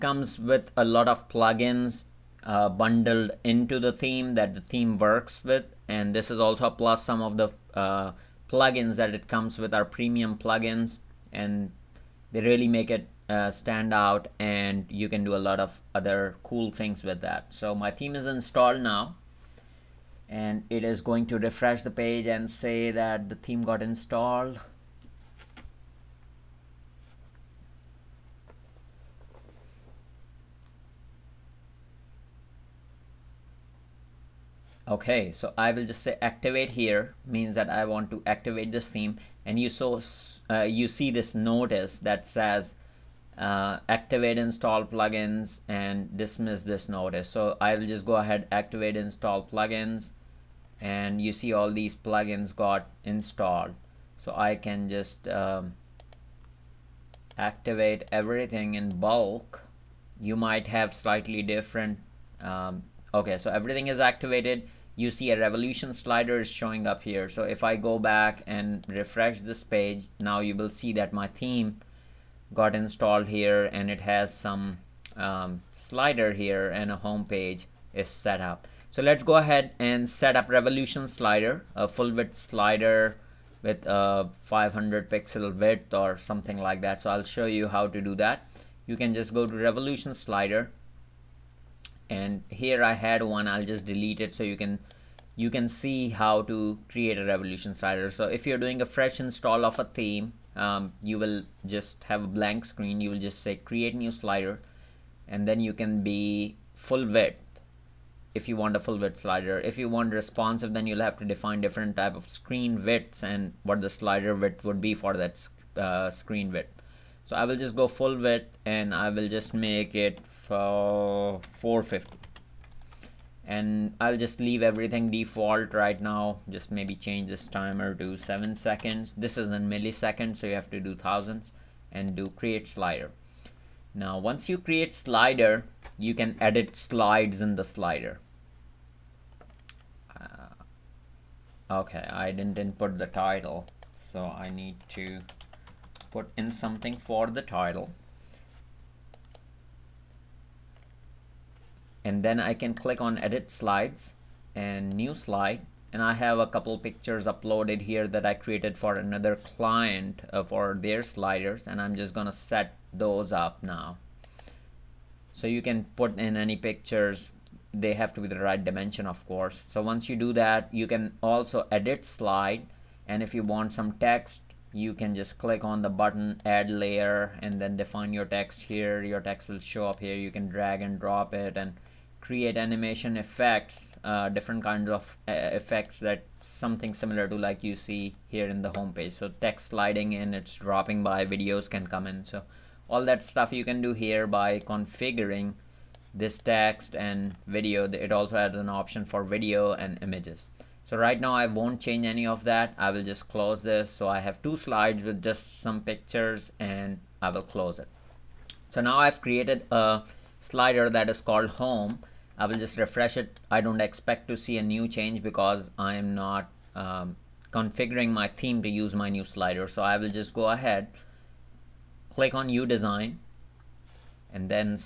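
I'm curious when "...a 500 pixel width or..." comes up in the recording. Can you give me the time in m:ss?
1:23.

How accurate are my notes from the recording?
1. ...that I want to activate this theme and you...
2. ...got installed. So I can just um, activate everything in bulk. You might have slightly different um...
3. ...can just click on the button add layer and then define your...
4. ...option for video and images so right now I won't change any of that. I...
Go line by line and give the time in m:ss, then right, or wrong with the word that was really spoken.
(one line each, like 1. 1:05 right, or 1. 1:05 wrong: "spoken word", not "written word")
1. 0:37 right
2. 0:52 right
3. 2:54 right
4. 3:18 right.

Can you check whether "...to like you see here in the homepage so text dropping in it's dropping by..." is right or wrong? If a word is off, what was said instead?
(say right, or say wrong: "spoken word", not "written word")
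wrong: "sliding", not "dropping".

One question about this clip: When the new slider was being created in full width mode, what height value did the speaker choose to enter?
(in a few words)
450.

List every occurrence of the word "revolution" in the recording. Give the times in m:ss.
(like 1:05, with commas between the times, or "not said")
1:05, 1:20, 1:29, 1:37.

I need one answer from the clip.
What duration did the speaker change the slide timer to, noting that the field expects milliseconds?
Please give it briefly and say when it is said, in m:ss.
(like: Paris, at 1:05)
7 seconds, at 2:08.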